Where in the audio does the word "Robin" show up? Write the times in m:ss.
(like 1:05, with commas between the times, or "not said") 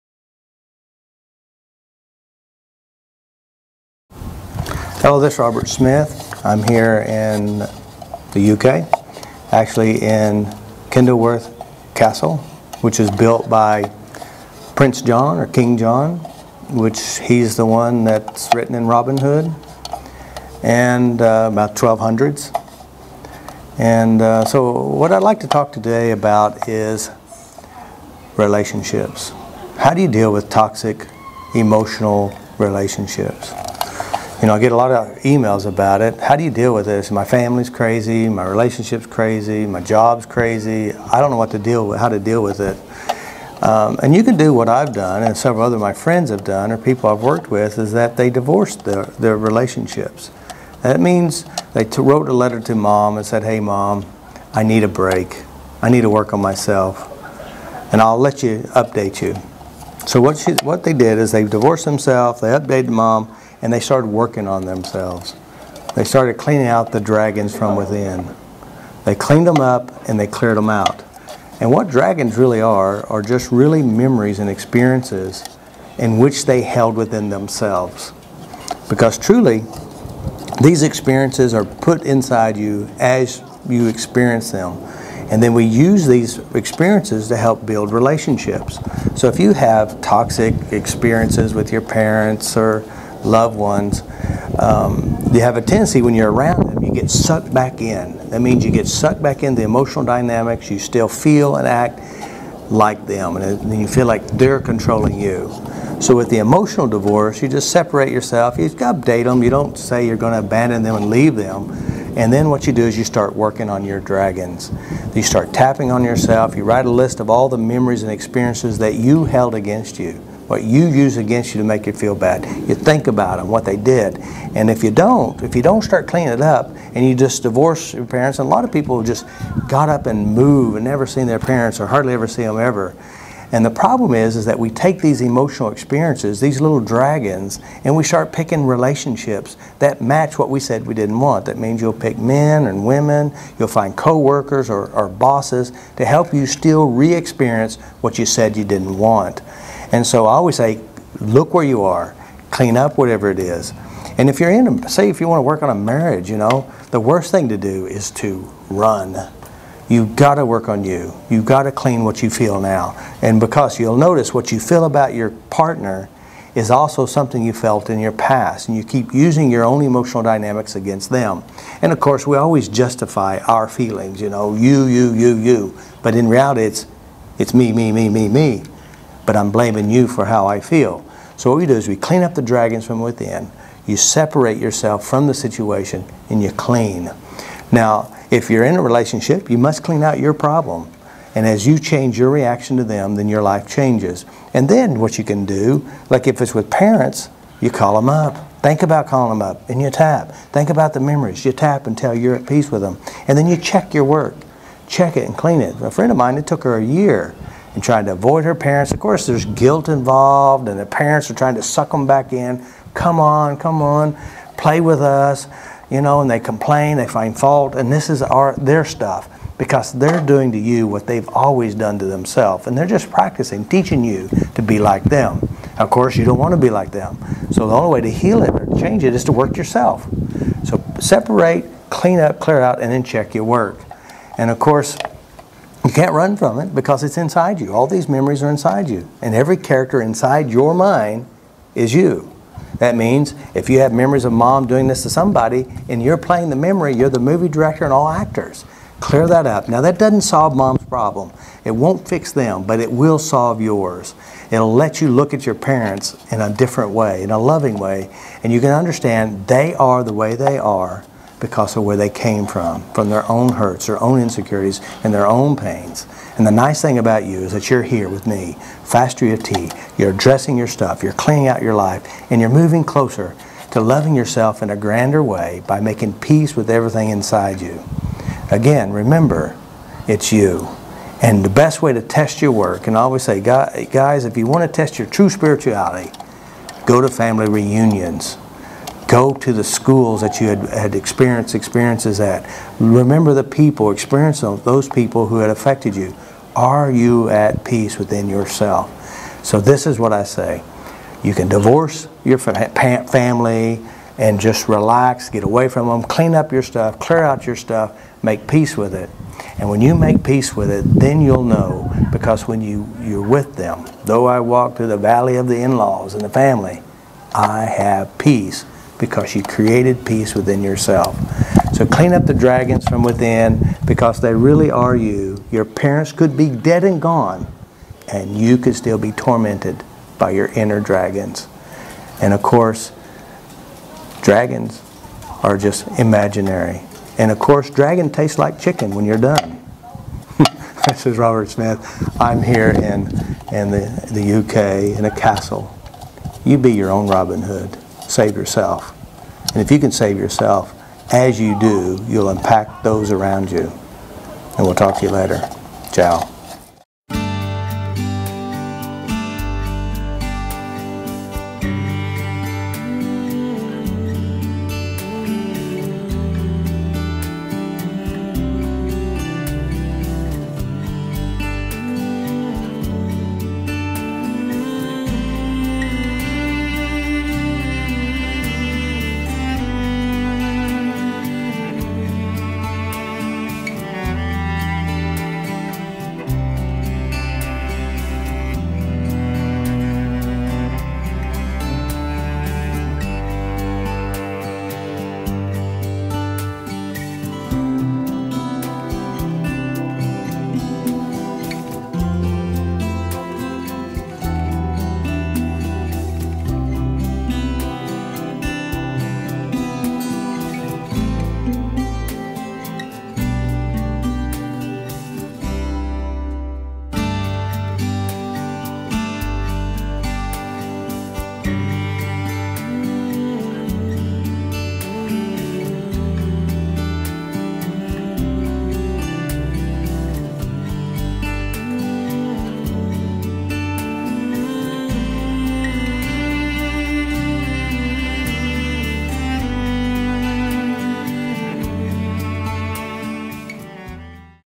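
0:18, 5:47.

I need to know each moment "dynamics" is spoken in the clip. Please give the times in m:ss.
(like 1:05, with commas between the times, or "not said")
1:40, 2:50.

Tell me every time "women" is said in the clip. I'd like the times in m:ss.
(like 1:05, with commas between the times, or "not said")
2:22.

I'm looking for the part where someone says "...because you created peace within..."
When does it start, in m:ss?
5:19.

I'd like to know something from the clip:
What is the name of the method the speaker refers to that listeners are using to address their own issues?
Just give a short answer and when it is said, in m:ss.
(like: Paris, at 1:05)
FasterEFT, at 4:28.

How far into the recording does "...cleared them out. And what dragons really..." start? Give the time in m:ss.
1:10.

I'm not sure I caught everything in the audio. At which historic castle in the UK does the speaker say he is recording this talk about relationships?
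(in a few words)
Kenilworth Castle.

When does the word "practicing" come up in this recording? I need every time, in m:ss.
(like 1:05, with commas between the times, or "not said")
3:43.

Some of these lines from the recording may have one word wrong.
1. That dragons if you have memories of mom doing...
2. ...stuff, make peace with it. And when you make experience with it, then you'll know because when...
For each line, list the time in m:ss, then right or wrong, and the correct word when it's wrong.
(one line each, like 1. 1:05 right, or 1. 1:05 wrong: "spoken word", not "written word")
1. 4:02 wrong: "means", not "dragons"
2. 5:07 wrong: "peace", not "experience".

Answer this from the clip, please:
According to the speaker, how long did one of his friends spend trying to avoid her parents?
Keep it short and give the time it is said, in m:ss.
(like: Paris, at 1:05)
a year, at 3:26.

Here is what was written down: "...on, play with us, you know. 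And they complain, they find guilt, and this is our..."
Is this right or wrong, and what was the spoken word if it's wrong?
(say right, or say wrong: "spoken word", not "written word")
wrong: "fault", not "guilt".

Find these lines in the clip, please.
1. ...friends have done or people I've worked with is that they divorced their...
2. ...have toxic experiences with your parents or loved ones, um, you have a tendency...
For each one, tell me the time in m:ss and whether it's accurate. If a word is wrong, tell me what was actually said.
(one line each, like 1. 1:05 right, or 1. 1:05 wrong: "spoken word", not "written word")
1. 0:45 right
2. 1:29 right.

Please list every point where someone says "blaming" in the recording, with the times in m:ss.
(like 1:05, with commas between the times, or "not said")
2:59.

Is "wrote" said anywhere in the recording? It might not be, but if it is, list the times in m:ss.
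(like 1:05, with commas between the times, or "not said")
0:52.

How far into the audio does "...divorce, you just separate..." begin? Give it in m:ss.
1:46.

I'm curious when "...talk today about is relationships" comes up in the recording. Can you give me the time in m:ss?
0:25.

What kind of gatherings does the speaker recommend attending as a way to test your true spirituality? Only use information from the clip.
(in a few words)
family reunions.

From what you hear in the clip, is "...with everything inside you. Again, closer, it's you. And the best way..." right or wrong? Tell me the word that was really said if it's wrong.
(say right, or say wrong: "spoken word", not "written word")
wrong: "remember", not "closer".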